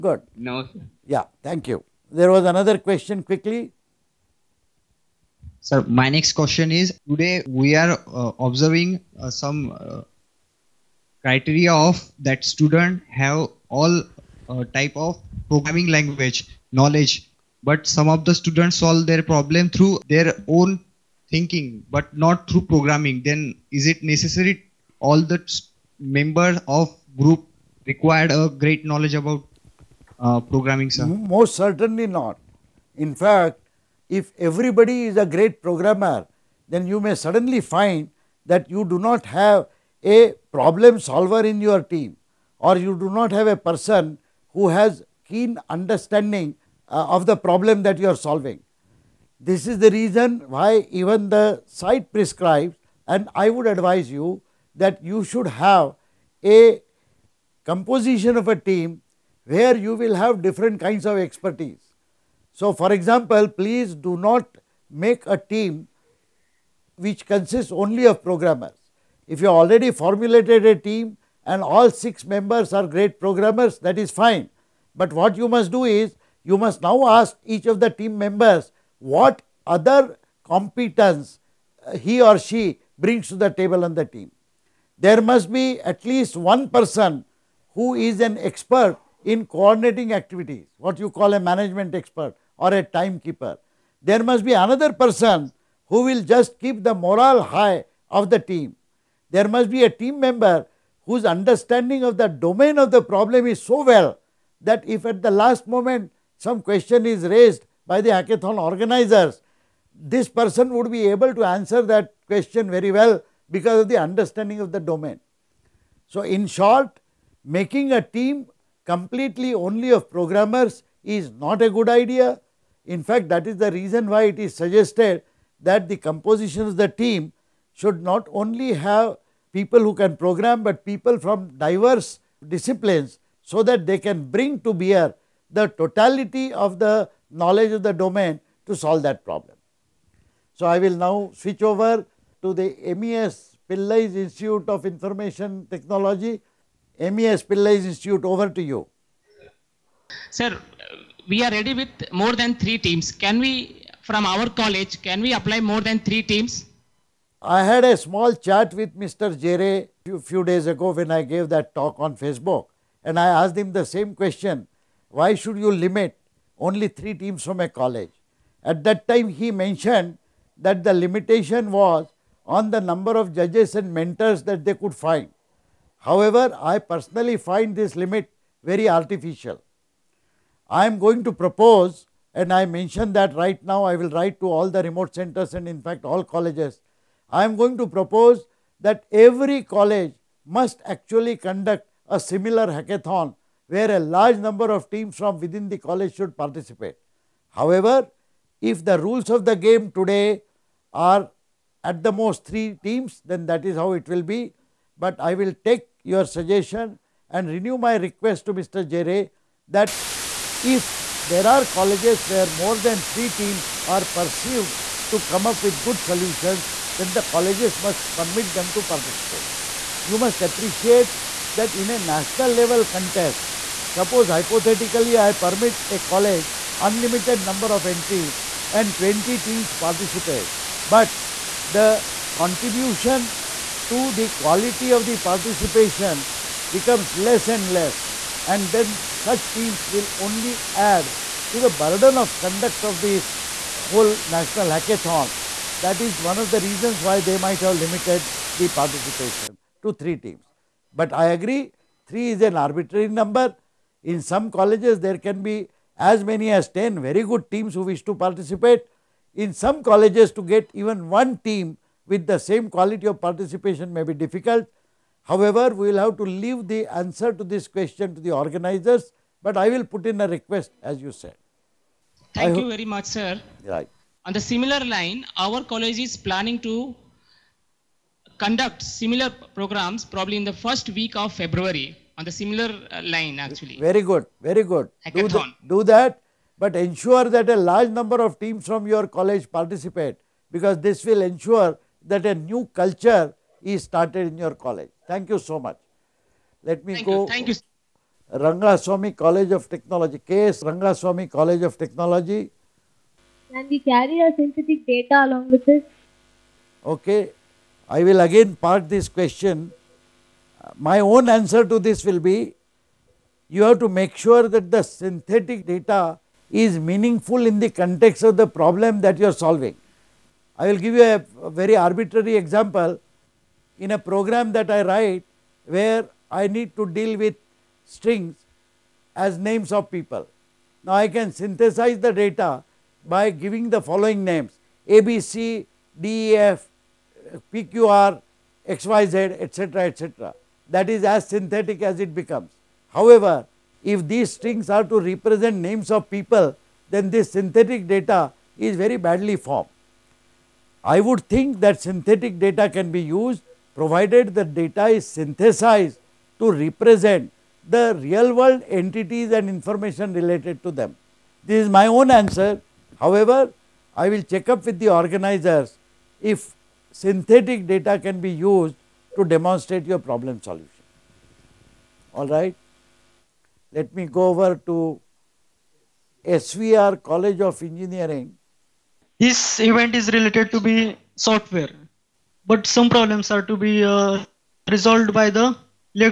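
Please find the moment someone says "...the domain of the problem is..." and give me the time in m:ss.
1:42.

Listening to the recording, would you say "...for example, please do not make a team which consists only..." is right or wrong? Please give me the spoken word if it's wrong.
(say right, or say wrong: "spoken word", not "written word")
right.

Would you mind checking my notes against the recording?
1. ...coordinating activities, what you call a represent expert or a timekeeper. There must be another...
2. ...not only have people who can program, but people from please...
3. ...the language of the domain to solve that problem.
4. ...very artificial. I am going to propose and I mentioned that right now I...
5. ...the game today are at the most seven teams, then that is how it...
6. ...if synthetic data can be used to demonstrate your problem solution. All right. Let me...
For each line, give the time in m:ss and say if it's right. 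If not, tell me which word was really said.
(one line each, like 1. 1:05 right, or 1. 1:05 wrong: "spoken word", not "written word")
1. 1:29 wrong: "management", not "represent"
2. 2:08 wrong: "diverse", not "please"
3. 2:16 wrong: "knowledge", not "language"
4. 2:58 right
5. 3:19 wrong: "three", not "seven"
6. 6:06 right.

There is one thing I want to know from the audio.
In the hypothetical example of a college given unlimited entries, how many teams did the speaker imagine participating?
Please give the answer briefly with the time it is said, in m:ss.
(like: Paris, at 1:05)
20, at 3:48.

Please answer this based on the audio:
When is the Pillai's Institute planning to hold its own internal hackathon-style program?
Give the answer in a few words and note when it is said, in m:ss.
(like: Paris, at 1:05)
first week of February, at 4:40.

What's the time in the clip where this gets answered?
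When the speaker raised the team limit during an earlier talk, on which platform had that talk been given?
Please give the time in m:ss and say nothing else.
2:42.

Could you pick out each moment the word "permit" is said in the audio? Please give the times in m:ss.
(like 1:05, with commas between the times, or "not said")
3:38, 3:45.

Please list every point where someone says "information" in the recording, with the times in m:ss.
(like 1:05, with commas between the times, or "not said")
2:24, 5:59.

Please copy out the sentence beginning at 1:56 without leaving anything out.
So, in short, making a team completely only of programmers is not a good idea.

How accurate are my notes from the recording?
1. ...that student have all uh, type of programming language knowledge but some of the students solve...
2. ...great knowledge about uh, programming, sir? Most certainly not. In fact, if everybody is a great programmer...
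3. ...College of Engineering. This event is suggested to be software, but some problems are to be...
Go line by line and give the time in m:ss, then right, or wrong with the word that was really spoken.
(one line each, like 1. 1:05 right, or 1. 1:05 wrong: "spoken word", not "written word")
1. 0:12 right
2. 0:28 right
3. 6:17 wrong: "related", not "suggested".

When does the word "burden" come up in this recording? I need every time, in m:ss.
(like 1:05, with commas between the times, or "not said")
4:01.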